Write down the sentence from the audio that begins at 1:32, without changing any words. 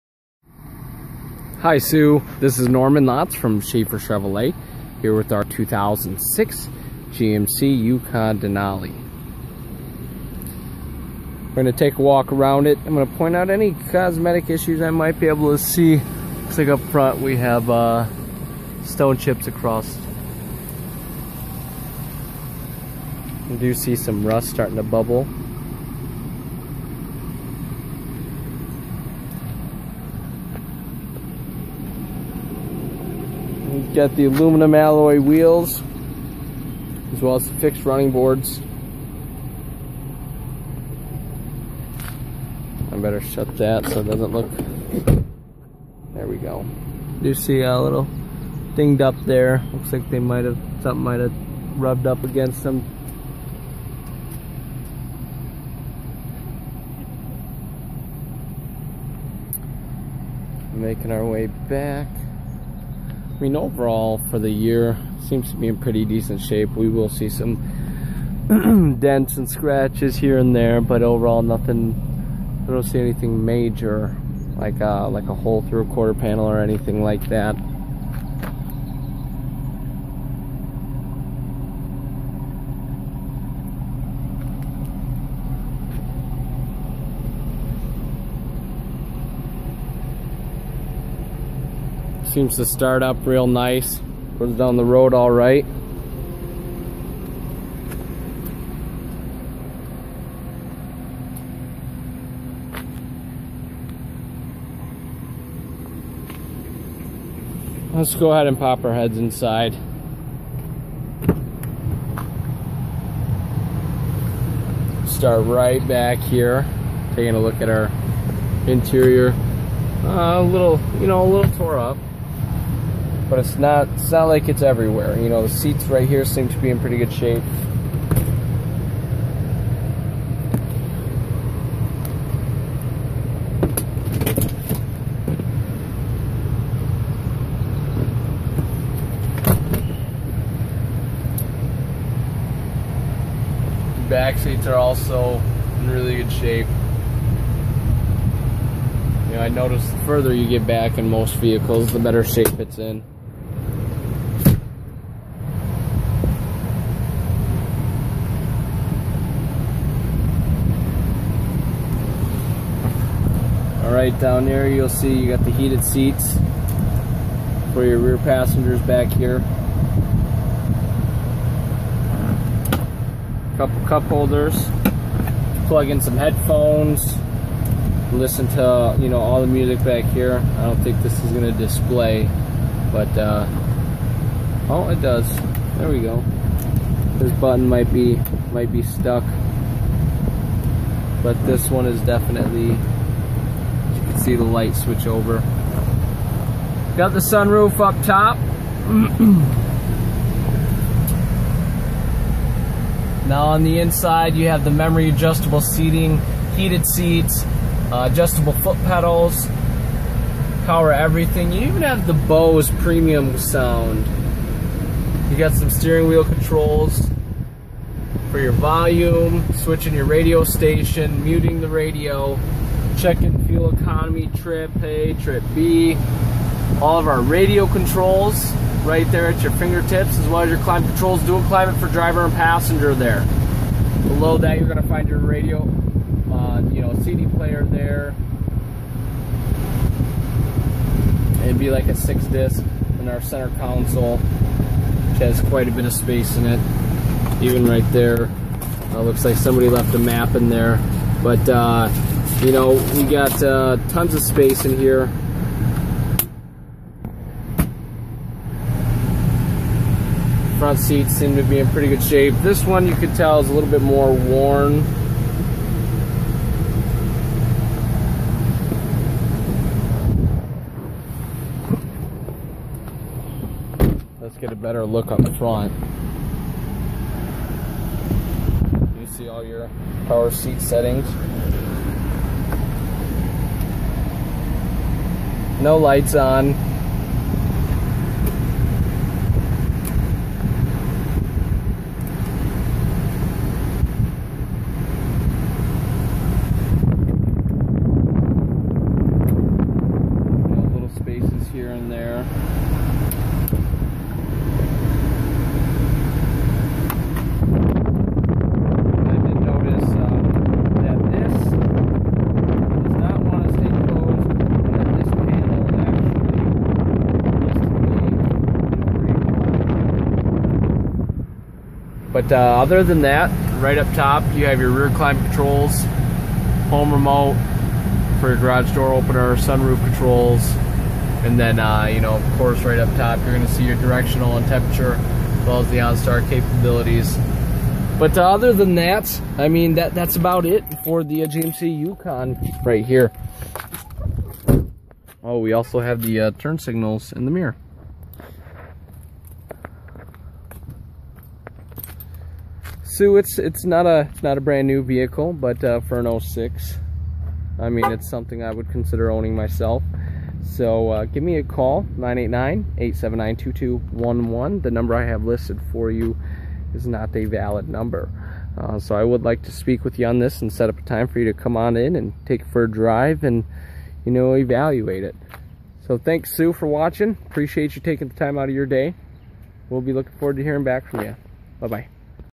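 Seems to start up real nice.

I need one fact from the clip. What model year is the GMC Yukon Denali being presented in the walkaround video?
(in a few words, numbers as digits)
2006.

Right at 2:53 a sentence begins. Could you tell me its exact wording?
Couple cup holders, plug in some headphones, listen to you know all the music back here.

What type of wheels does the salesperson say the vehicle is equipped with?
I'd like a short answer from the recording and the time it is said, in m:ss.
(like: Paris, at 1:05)
aluminum alloy wheels, at 0:34.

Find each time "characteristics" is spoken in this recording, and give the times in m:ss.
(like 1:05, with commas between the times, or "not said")
not said.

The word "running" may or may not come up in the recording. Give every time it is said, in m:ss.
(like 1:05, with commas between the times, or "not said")
0:37.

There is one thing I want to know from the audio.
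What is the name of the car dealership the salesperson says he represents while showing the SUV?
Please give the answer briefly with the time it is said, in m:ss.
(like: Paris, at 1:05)
Schafer Chevrolet, at 0:03.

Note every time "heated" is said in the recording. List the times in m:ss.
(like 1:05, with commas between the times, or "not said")
2:45, 3:26.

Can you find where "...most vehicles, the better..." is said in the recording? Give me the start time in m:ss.
2:31.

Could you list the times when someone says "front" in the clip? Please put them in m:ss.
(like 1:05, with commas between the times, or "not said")
0:16, 4:20, 4:35.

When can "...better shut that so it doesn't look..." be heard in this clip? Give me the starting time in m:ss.
0:42.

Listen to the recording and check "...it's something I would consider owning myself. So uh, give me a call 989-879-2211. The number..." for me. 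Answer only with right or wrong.
right.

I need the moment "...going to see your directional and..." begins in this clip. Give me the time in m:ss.
5:33.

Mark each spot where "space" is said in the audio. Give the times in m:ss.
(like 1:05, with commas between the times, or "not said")
4:05, 4:14.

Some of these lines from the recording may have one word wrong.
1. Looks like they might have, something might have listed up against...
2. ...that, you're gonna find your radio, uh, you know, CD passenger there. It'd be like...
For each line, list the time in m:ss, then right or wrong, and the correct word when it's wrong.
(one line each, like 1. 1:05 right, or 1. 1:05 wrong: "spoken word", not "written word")
1. 0:49 wrong: "rubbed", not "listed"
2. 3:54 wrong: "player", not "passenger".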